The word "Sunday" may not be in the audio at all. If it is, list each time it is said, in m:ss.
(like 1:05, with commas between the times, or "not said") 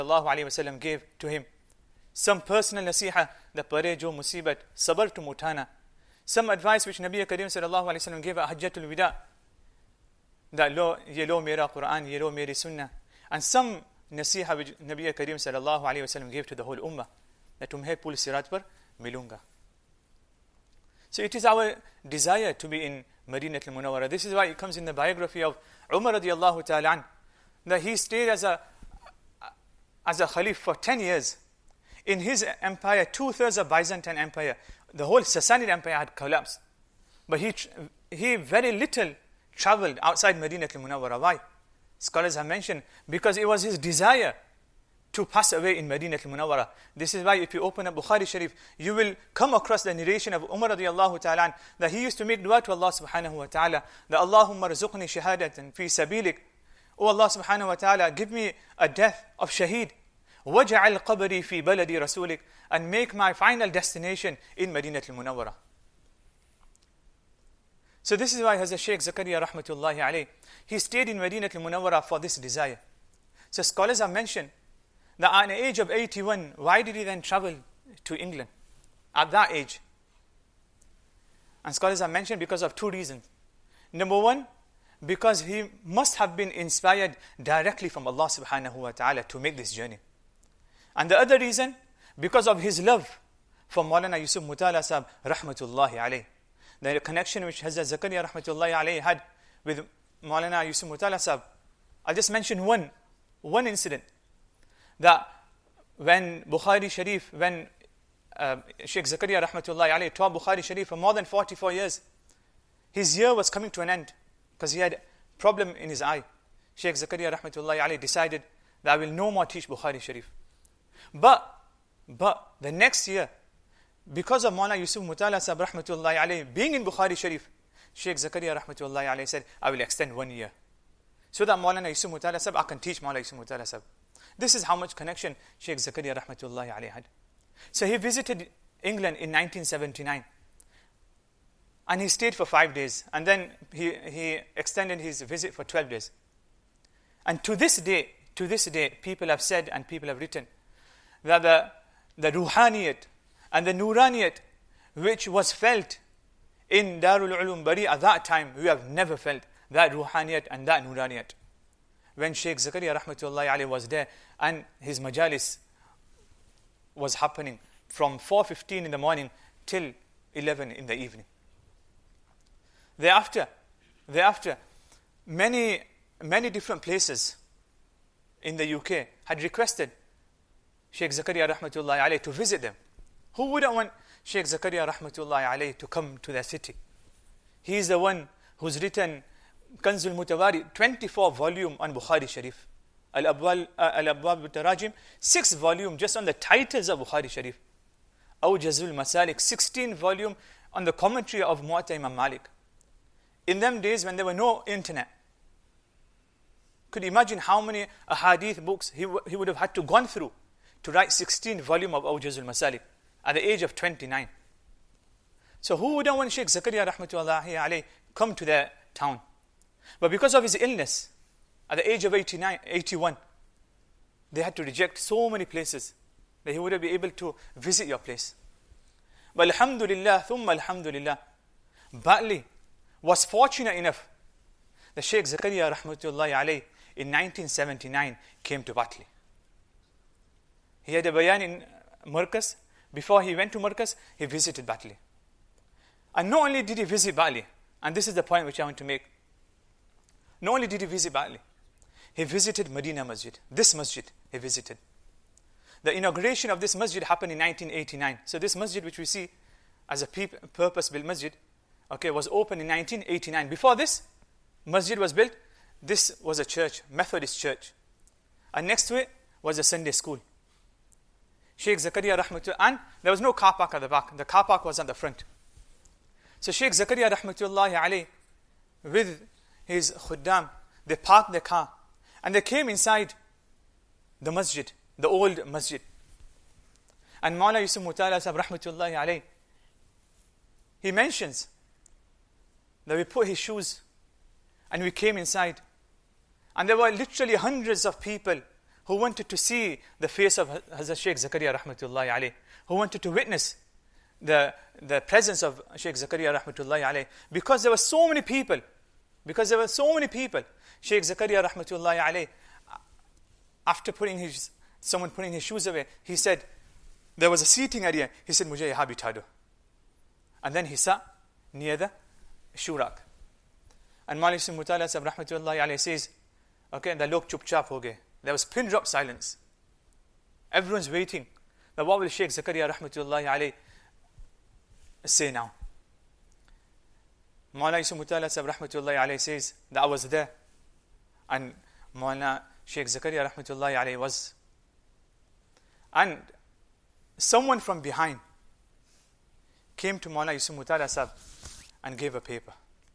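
4:29.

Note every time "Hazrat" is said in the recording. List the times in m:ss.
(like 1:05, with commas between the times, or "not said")
1:08, 1:37, 5:00.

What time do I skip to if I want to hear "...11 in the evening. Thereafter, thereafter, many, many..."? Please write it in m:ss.
2:50.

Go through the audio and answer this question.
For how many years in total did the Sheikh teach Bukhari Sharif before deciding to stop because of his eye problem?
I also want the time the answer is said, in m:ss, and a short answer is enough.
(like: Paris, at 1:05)
more than 44 years, at 1:50.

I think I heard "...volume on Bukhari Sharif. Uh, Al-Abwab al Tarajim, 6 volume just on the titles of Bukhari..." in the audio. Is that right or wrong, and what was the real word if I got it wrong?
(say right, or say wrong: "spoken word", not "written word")
right.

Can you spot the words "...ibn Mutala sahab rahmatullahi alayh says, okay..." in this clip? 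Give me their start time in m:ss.
5:24.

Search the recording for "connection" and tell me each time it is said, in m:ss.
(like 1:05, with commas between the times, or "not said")
1:36, 2:14.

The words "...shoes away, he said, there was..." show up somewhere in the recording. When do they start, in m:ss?
5:15.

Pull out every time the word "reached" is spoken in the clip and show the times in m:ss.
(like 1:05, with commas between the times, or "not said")
not said.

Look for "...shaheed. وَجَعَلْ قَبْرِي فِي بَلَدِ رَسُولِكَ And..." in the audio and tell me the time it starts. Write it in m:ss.
0:59.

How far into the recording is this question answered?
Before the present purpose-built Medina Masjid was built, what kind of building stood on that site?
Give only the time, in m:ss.
4:26.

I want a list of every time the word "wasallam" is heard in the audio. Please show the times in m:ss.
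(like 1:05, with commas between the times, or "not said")
0:00, 0:08, 0:16.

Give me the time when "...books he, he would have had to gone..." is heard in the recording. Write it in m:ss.
3:28.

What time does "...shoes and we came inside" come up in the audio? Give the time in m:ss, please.
4:53.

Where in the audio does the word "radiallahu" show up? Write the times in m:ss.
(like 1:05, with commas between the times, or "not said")
0:26, 0:50.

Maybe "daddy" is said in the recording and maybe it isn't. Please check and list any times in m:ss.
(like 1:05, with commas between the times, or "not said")
not said.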